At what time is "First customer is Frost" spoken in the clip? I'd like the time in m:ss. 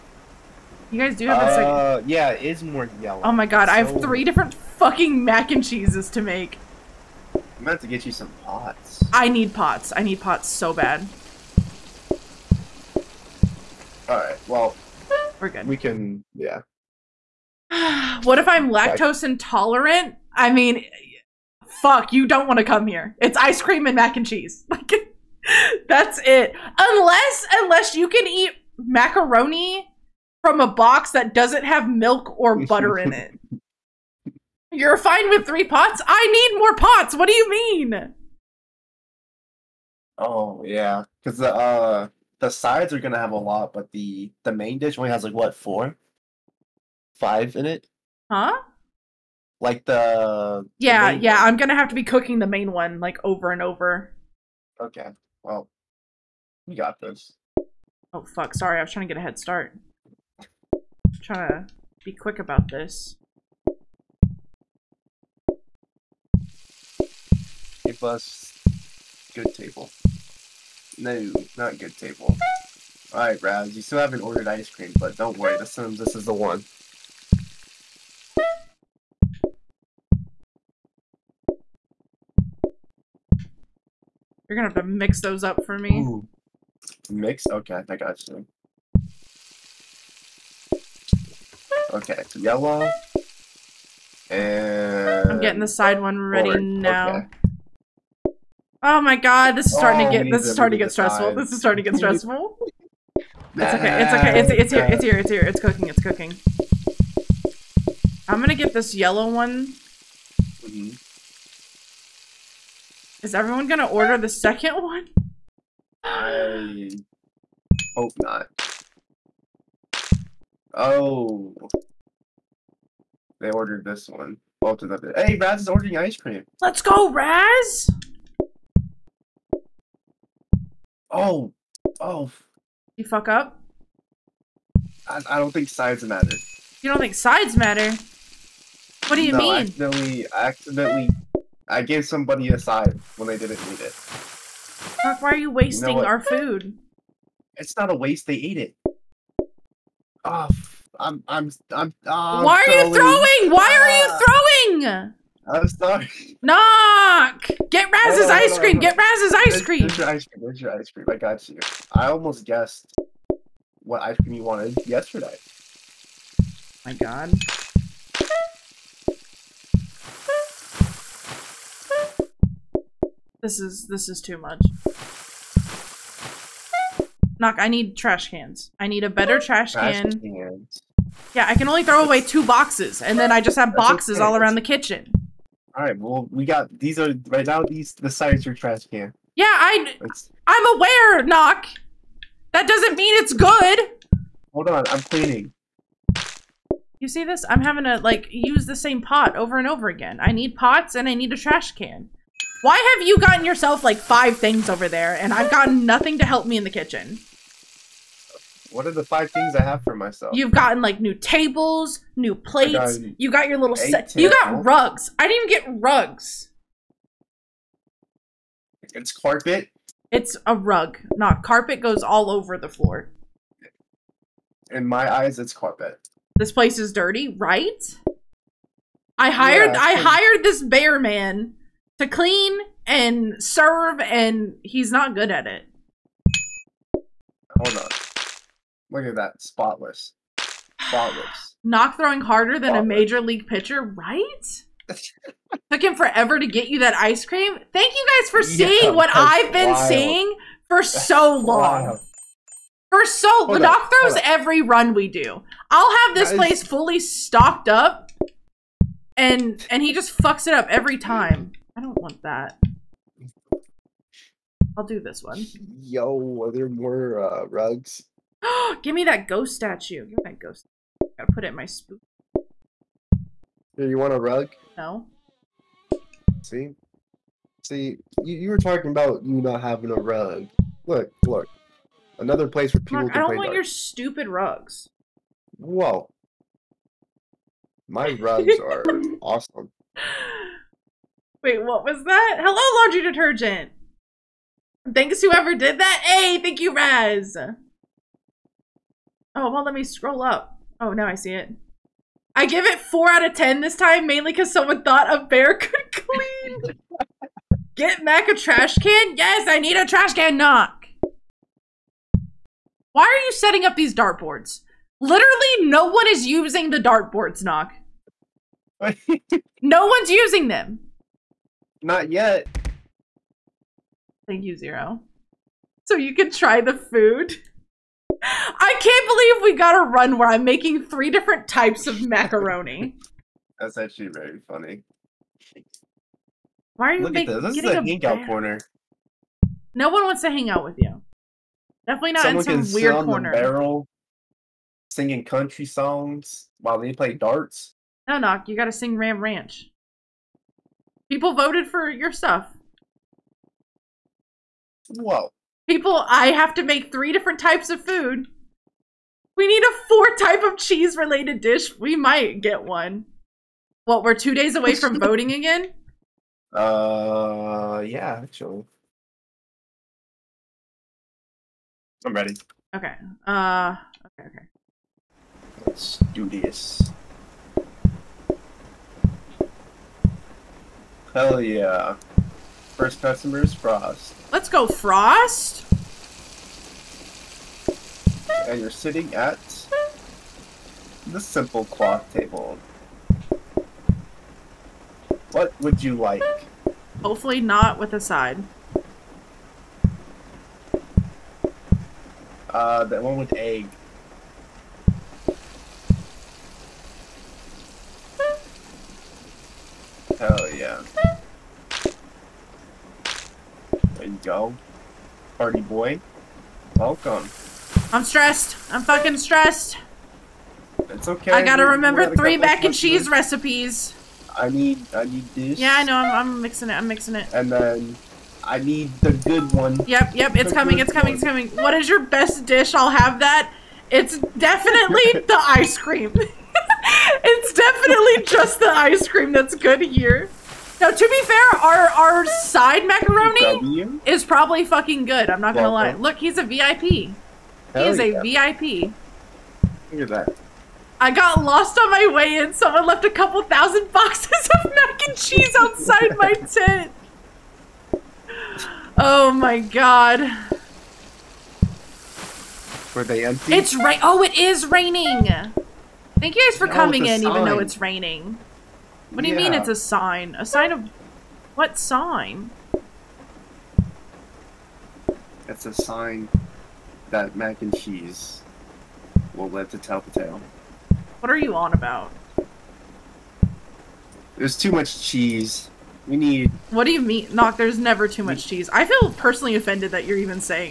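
6:22.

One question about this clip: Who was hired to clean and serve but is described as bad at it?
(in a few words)
Bear man.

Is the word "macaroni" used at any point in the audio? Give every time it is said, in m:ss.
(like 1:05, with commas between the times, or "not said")
0:28, 5:32, 7:22.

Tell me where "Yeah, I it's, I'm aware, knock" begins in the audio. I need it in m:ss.
3:09.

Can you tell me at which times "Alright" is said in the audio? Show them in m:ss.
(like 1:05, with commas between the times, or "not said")
0:14, 1:13.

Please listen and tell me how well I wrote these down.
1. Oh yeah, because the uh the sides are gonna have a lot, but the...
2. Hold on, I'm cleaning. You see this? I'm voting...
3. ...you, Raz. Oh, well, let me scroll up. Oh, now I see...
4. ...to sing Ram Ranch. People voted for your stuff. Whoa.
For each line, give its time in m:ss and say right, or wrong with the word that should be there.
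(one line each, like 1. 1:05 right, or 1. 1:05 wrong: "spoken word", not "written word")
1. 0:40 right
2. 3:14 wrong: "having", not "voting"
3. 4:56 right
4. 5:48 right.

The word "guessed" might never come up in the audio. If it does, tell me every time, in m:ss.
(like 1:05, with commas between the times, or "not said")
2:42.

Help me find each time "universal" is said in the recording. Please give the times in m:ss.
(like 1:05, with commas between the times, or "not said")
not said.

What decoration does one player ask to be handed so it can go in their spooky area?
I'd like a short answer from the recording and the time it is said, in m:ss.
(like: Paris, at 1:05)
Ghost statue, at 4:29.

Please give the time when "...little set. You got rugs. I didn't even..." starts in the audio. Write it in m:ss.
3:33.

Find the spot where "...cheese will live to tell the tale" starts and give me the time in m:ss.
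7:57.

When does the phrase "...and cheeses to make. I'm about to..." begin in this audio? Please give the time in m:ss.
0:05.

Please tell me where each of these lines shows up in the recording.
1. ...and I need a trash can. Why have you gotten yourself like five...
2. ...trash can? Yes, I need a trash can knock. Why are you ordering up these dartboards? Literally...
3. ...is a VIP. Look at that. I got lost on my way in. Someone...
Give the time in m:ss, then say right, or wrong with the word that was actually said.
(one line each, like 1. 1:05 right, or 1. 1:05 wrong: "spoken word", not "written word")
1. 3:20 right
2. 5:08 wrong: "setting", not "ordering"
3. 7:27 right.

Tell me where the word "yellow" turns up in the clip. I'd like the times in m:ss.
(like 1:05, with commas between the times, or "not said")
0:03, 1:32, 1:48.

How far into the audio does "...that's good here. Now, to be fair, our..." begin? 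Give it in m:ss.
7:19.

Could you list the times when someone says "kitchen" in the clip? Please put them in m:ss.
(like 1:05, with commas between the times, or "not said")
3:04, 3:26.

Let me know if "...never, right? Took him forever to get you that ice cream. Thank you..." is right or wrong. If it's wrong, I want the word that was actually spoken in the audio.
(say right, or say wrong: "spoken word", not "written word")
wrong: "pitcher", not "never".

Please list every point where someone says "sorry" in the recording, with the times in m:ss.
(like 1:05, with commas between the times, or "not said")
0:58, 2:35.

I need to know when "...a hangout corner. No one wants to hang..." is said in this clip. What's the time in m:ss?
5:37.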